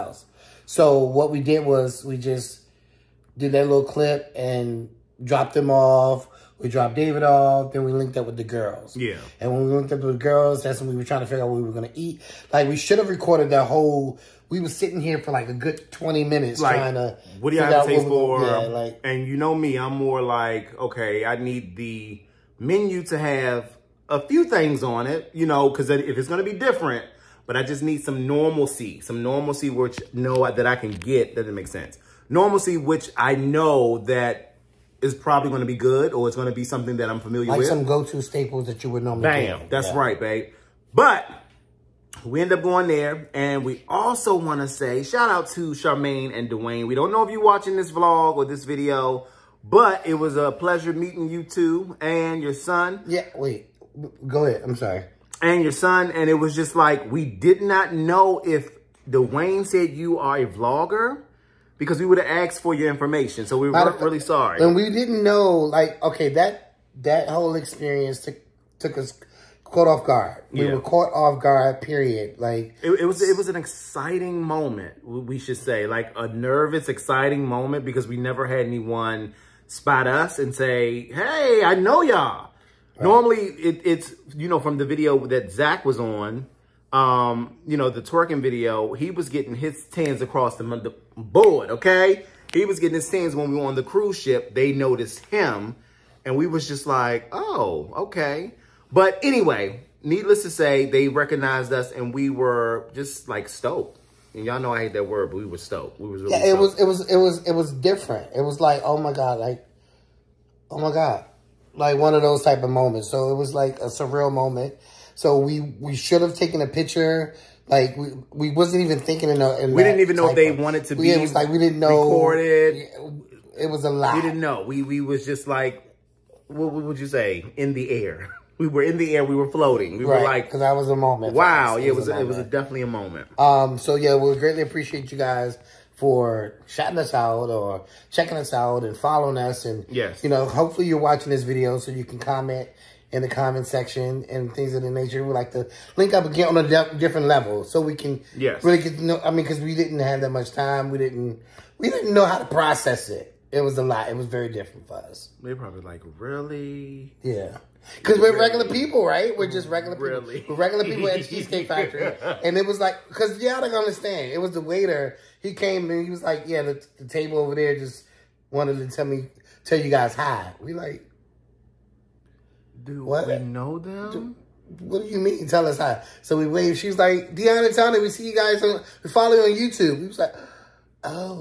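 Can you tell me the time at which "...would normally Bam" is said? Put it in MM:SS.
00:38.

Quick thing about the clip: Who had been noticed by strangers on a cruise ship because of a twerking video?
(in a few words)
Zach.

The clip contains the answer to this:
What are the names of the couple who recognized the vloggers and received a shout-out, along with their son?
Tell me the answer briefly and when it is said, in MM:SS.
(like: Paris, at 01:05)
Charmaine and Dwayne, at 00:45.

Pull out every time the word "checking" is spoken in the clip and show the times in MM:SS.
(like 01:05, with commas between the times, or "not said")
02:18.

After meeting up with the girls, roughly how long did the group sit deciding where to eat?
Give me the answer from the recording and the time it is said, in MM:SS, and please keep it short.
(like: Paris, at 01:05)
20 minutes, at 00:15.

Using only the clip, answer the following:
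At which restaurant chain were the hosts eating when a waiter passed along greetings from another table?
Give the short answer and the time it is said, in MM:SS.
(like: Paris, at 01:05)
Cheesecake Factory, at 02:41.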